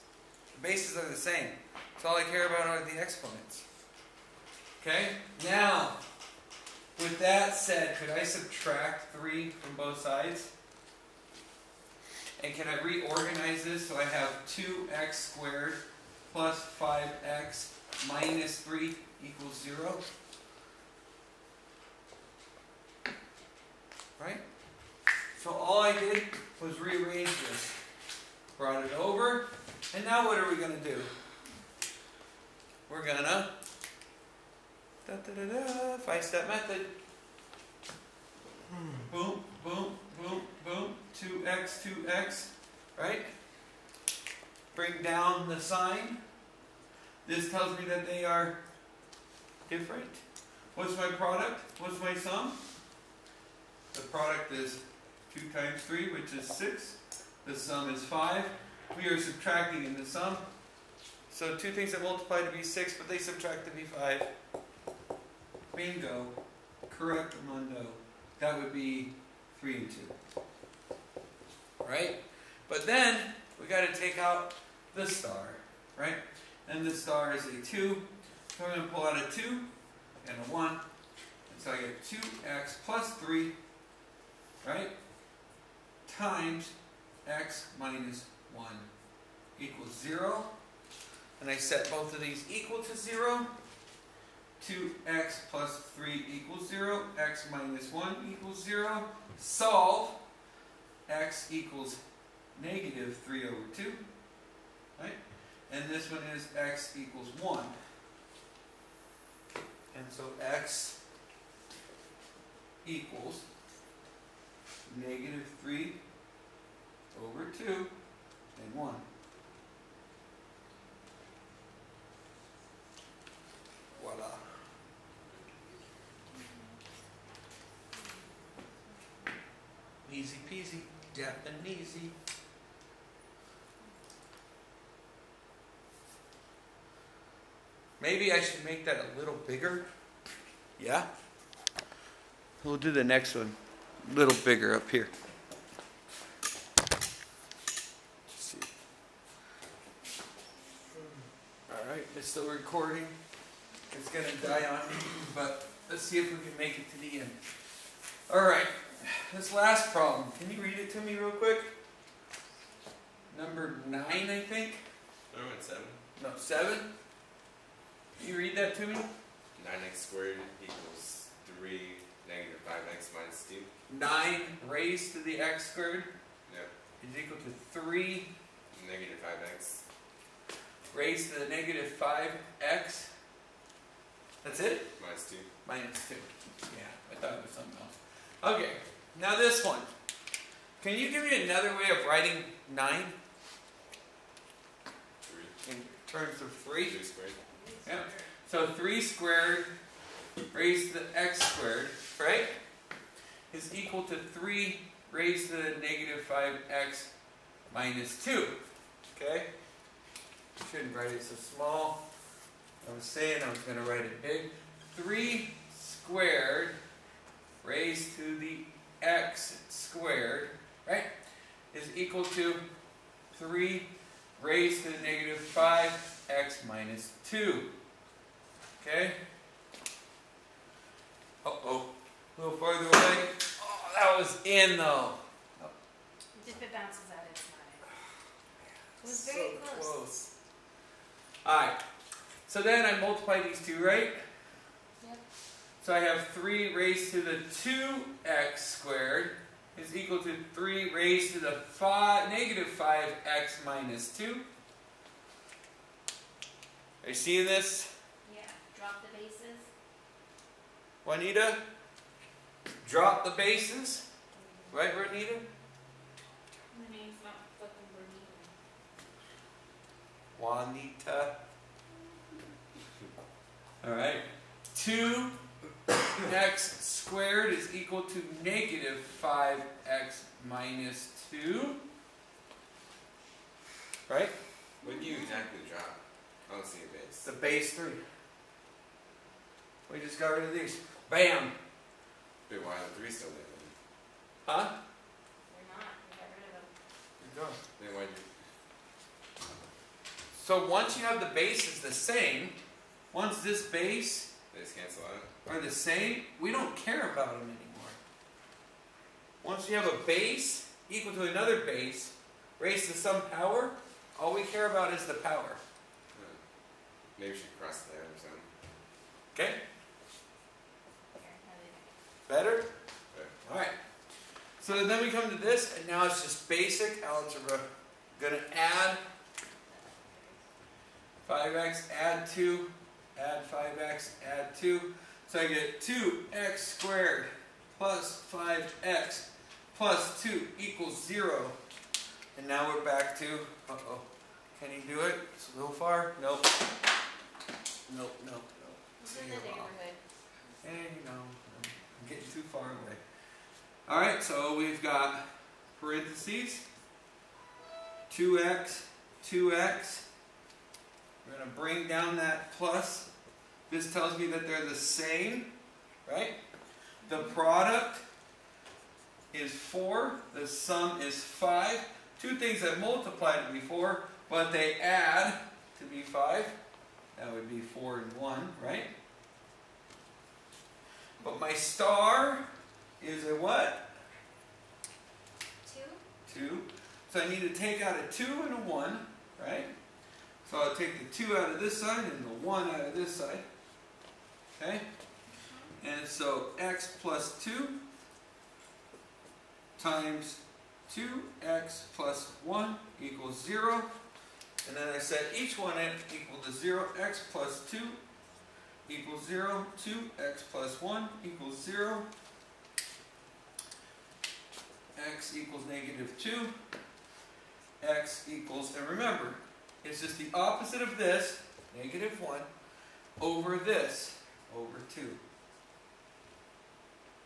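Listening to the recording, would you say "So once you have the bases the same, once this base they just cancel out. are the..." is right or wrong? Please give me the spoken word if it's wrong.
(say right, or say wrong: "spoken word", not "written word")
right.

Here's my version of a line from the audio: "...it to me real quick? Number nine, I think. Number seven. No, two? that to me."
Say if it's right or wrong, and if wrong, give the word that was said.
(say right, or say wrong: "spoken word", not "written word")
wrong: "seven", not "two".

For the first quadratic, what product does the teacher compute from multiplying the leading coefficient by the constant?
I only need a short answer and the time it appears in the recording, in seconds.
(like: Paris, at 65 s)
6, at 56 s.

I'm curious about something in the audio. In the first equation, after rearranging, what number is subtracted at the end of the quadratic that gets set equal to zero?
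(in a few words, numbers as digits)
3.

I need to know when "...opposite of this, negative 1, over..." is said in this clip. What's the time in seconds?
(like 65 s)
420 s.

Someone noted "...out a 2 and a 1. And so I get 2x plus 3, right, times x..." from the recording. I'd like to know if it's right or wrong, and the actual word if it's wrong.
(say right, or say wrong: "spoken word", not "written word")
right.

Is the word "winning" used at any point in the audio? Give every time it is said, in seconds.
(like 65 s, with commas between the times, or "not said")
not said.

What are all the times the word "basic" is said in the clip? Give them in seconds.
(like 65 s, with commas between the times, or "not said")
326 s.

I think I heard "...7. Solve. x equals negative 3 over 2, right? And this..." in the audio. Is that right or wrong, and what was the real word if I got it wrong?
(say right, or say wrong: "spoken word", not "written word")
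wrong: "0", not "7".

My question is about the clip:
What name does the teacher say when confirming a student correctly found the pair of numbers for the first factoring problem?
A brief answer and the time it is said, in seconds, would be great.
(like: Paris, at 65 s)
Mundo, at 67 s.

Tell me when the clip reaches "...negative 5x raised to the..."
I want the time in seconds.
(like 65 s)
178 s.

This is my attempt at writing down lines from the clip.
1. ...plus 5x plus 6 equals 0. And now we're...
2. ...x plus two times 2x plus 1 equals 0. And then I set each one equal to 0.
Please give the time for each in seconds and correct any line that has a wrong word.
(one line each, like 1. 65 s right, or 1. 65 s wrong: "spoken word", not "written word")
1. 337 s wrong: "2", not "6"
2. 396 s right.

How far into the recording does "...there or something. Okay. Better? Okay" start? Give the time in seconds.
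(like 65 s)
317 s.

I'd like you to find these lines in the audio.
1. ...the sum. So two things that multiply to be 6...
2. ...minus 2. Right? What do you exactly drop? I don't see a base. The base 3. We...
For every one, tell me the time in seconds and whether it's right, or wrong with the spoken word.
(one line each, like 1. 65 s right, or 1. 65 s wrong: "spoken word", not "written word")
1. 59 s right
2. 280 s right.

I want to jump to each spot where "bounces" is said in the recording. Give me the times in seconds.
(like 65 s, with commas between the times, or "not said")
236 s.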